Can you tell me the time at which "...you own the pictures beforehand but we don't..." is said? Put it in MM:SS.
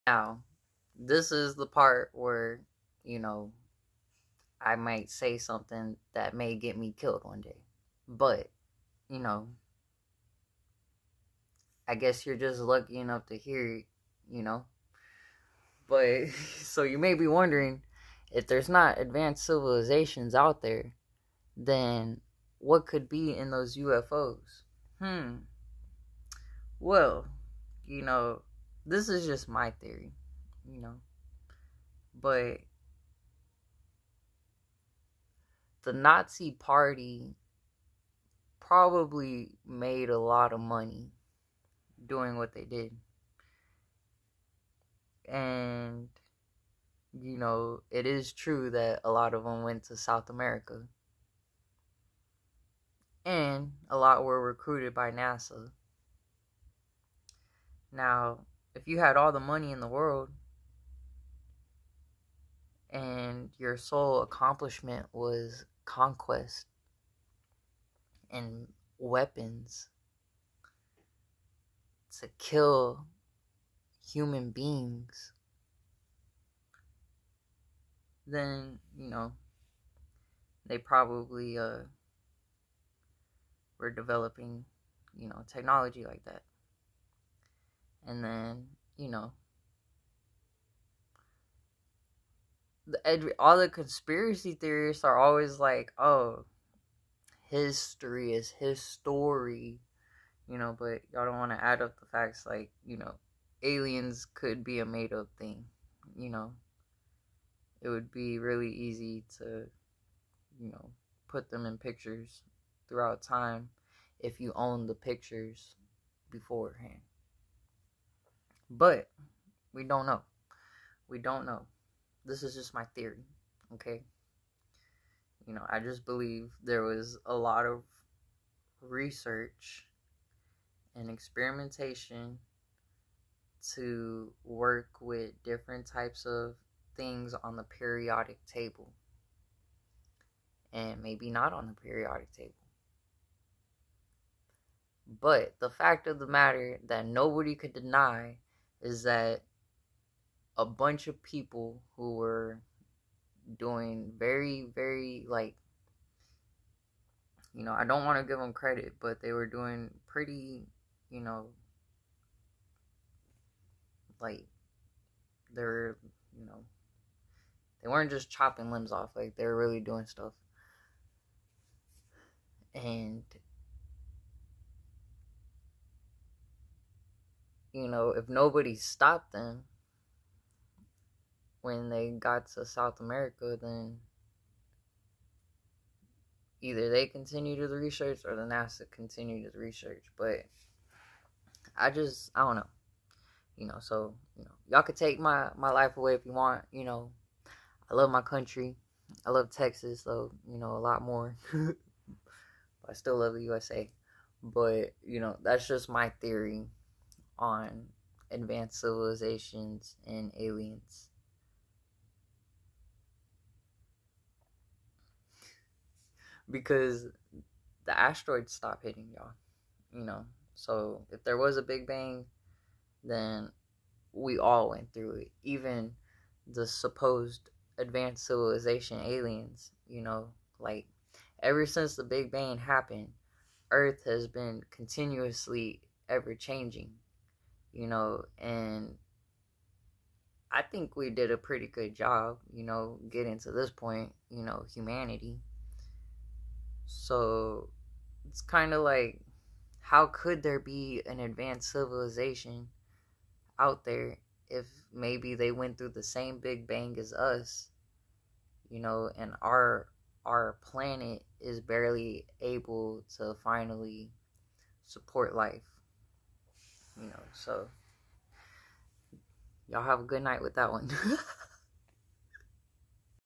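01:54.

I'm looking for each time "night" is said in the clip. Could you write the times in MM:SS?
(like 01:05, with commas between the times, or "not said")
04:30.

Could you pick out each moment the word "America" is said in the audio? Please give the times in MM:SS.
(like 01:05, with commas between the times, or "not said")
00:50, 03:02.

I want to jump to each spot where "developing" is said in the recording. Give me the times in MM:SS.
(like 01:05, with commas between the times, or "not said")
01:23.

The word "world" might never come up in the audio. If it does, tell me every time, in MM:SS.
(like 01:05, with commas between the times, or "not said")
00:59.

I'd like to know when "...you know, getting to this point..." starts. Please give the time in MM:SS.
04:02.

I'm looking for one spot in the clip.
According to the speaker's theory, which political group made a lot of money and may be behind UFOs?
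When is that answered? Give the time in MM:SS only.
00:35.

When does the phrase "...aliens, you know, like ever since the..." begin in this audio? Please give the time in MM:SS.
03:48.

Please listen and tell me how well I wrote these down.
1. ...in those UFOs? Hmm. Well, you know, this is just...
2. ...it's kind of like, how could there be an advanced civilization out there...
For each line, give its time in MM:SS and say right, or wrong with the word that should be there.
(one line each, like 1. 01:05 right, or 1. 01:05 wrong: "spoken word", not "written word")
1. 00:23 right
2. 04:08 right.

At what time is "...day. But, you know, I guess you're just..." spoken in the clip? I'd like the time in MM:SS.
00:07.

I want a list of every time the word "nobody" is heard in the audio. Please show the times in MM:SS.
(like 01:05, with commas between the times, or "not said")
02:27, 02:58.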